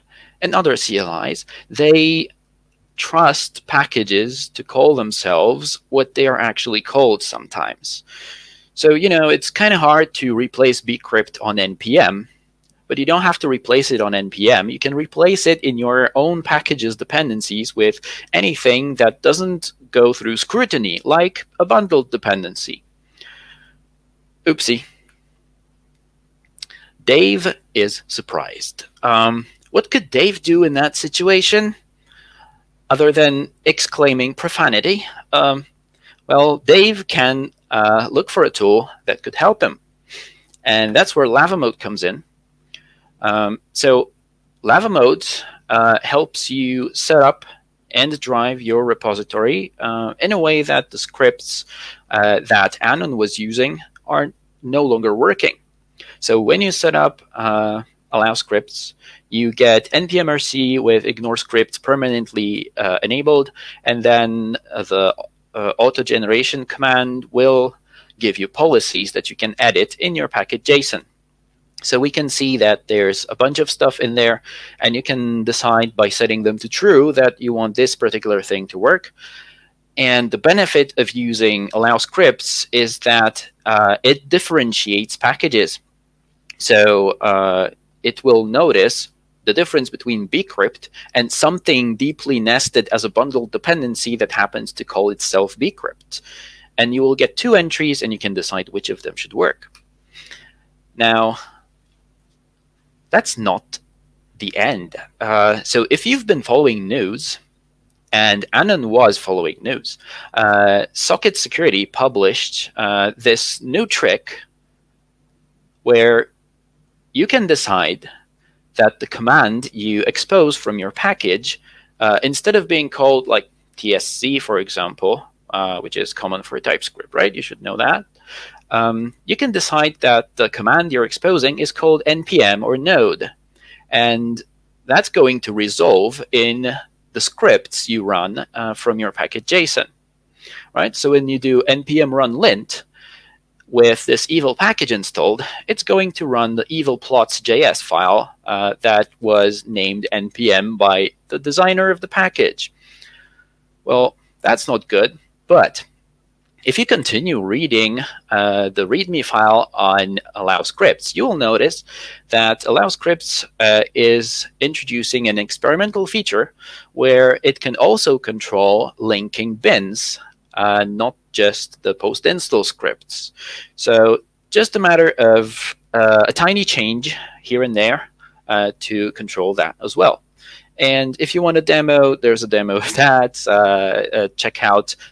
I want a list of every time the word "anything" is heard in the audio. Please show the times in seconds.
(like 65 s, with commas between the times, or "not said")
18 s.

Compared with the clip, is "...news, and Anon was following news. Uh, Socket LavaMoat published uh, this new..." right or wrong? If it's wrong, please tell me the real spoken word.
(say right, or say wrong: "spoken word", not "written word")
wrong: "Security", not "LavaMoat".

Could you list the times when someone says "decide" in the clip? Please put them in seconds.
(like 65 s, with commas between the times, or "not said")
75 s, 98 s, 117 s, 129 s.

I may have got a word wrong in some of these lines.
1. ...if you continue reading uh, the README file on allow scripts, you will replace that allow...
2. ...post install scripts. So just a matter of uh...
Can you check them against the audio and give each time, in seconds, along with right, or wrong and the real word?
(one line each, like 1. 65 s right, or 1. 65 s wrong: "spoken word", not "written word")
1. 156 s wrong: "notice", not "replace"
2. 171 s right.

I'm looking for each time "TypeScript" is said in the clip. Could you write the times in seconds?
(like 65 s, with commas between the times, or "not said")
126 s.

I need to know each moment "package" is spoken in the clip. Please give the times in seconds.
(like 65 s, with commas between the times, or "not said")
3 s, 16 s, 70 s, 85 s, 120 s, 139 s, 144 s, 152 s.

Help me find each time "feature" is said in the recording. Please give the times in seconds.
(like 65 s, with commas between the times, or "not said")
166 s.